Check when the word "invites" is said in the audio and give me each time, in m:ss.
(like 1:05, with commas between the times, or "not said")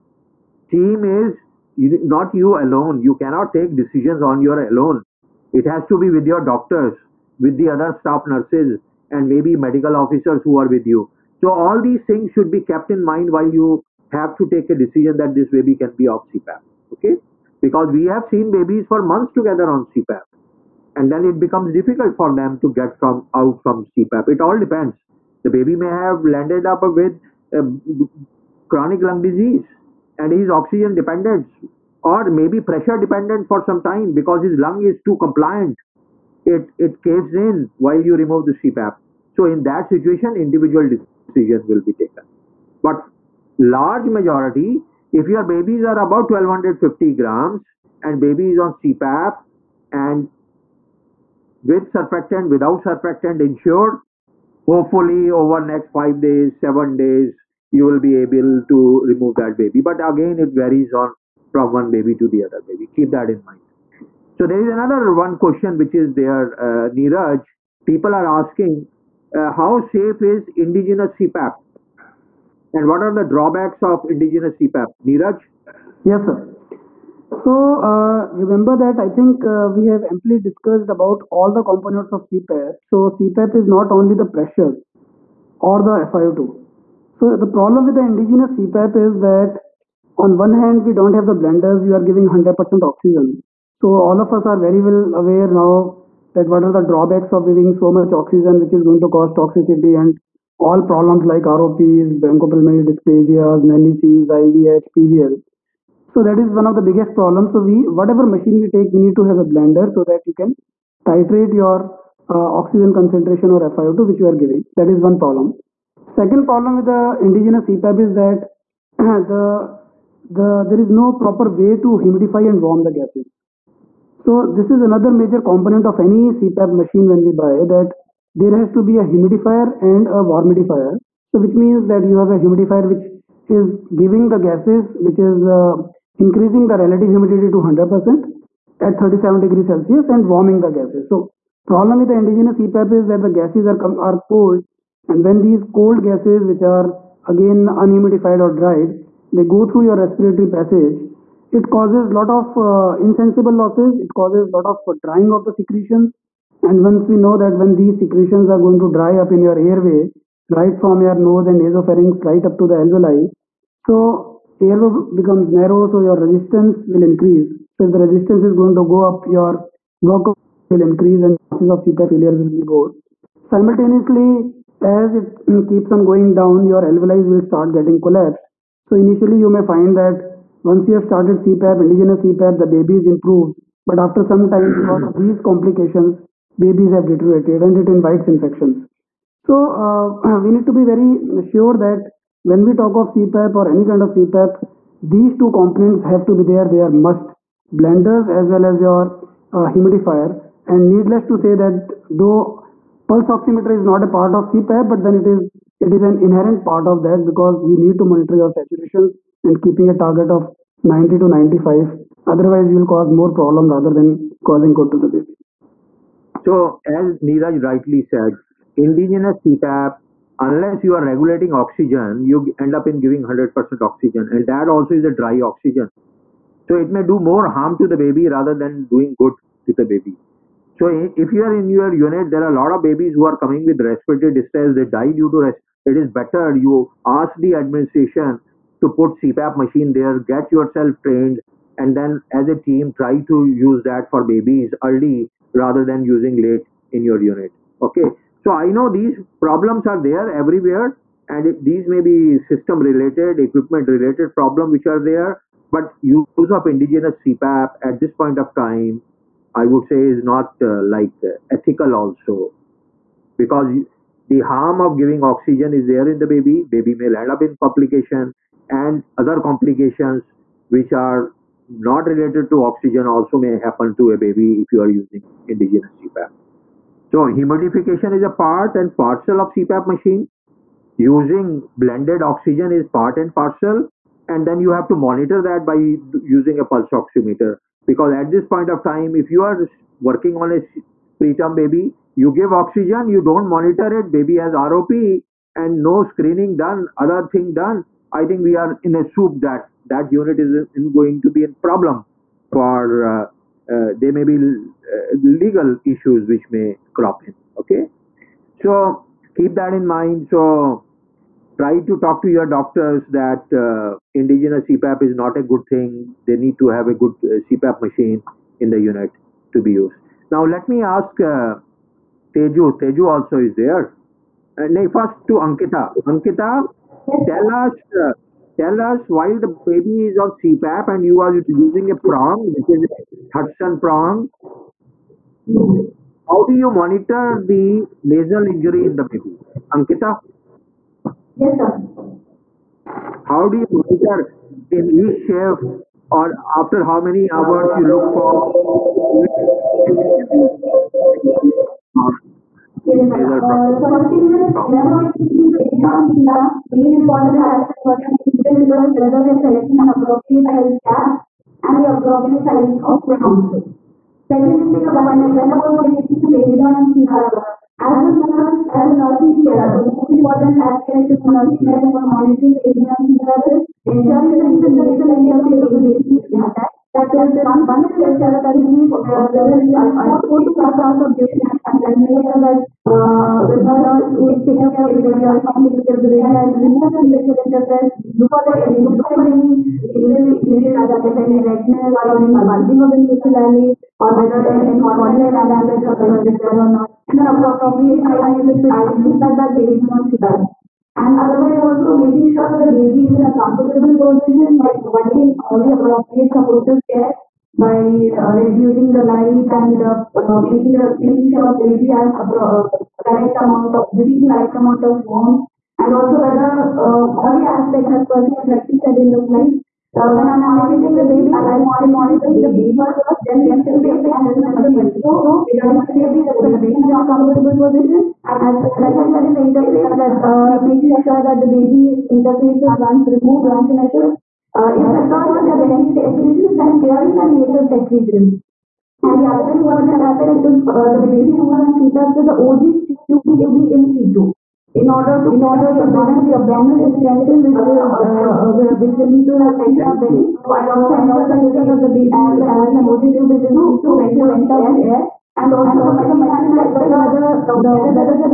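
3:07.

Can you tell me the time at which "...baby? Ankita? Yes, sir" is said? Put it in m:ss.
5:39.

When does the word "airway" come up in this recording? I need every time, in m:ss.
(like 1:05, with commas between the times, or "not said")
2:39, 2:44.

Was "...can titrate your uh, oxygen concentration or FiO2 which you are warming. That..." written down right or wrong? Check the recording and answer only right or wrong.
wrong.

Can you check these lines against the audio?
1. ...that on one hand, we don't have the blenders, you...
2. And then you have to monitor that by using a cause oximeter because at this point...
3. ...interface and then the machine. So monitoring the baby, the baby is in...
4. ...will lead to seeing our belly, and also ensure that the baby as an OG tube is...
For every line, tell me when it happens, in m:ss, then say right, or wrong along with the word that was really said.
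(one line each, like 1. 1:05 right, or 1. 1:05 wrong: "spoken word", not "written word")
1. 1:29 right
2. 4:44 wrong: "pulse", not "cause"
3. 7:03 wrong: "regarding", not "monitoring"
4. 7:28 right.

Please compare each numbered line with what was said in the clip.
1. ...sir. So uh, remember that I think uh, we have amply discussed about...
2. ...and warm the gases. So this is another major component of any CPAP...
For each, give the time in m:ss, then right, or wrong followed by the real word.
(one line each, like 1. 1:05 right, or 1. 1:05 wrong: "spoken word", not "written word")
1. 1:16 right
2. 2:02 right.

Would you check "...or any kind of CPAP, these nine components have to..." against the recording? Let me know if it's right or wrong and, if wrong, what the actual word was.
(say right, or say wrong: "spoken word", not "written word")
wrong: "two", not "nine".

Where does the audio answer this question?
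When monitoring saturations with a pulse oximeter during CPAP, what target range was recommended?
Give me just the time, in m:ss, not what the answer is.
3:30.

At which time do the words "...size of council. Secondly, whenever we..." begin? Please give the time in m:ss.
6:02.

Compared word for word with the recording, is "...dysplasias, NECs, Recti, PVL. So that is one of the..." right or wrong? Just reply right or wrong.
wrong.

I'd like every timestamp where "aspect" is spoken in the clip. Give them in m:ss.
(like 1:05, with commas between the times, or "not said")
5:57, 6:10, 6:57, 7:20.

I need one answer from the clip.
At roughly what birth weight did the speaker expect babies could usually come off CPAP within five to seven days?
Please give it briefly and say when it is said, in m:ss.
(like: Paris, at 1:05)
1250 grams, at 0:46.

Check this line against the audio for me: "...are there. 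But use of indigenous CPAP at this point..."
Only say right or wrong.
right.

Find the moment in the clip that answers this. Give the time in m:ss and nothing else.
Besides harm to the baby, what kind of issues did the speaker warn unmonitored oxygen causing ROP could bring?
5:05.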